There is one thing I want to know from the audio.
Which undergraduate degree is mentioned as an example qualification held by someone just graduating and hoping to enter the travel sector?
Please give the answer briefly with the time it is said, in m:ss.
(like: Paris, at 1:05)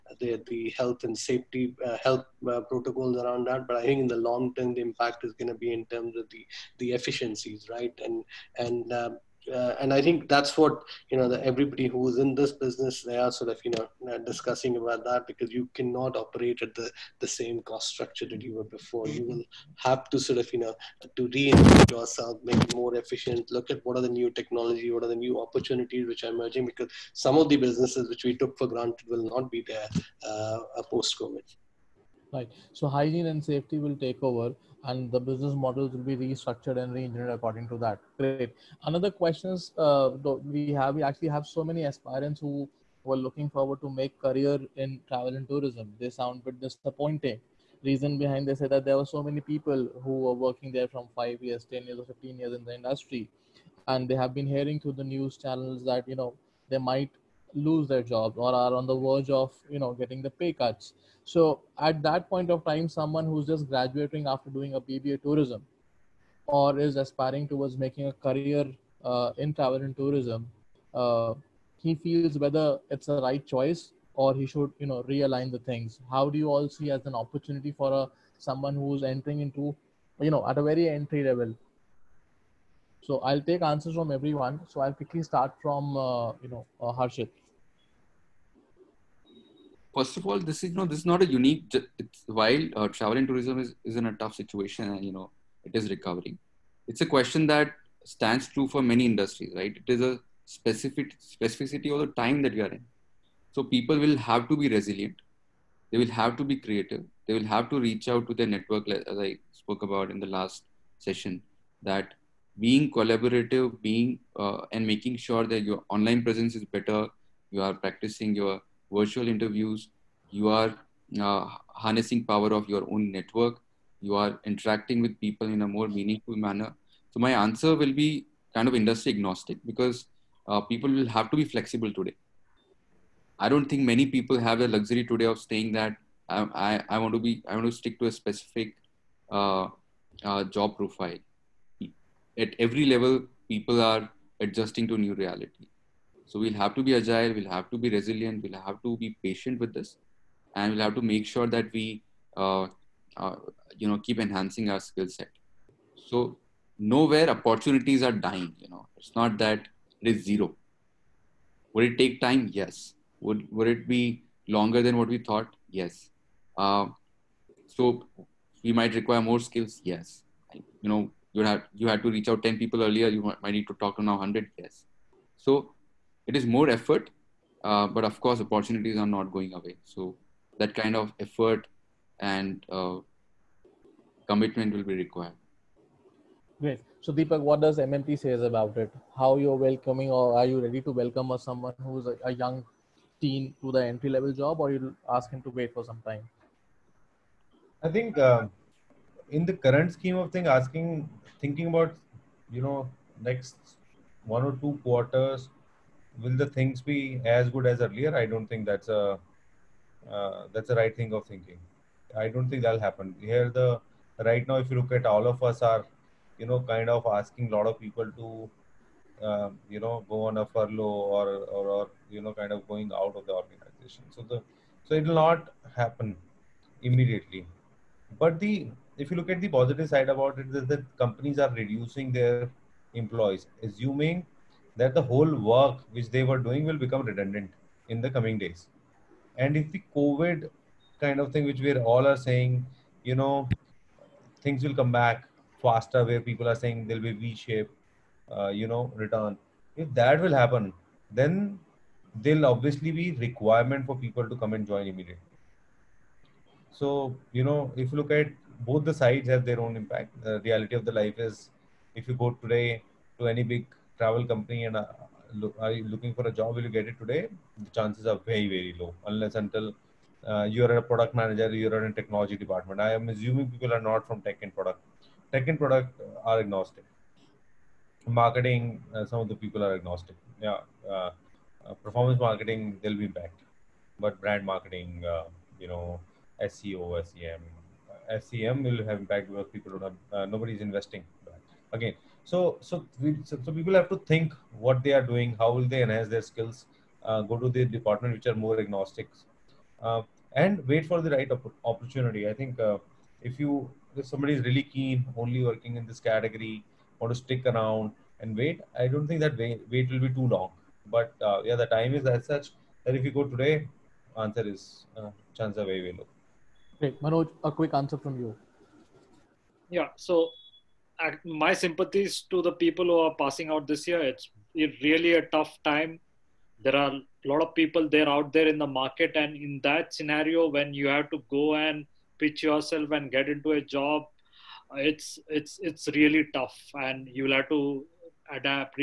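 BBA tourism, at 1:04.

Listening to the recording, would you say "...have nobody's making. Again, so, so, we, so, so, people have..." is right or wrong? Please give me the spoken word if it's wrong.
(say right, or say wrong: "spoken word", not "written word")
wrong: "investing", not "making".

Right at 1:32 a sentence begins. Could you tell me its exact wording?
while uh, travel and tourism is, is in a tough situation, and uh, you know it is recovering.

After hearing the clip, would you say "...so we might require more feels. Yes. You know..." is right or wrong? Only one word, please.
wrong.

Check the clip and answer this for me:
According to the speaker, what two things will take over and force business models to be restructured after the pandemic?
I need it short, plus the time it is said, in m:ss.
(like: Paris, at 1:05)
hygiene and safety, at 0:32.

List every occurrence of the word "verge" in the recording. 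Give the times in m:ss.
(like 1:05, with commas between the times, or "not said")
0:58.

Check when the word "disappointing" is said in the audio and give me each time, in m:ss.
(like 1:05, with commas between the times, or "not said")
0:46.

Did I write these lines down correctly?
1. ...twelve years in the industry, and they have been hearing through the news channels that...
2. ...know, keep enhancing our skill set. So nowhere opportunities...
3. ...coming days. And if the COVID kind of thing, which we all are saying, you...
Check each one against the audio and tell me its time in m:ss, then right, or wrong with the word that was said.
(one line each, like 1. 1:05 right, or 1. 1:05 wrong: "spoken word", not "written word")
1. 0:52 wrong: "fifteen", not "twelve"
2. 2:33 right
3. 3:58 right.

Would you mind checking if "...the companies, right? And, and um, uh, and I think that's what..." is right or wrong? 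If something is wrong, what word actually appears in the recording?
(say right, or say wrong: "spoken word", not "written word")
wrong: "efficiencies", not "companies".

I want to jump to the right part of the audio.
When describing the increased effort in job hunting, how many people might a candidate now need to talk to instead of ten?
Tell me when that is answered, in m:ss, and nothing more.
2:54.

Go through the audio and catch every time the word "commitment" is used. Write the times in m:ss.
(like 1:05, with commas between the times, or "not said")
3:04.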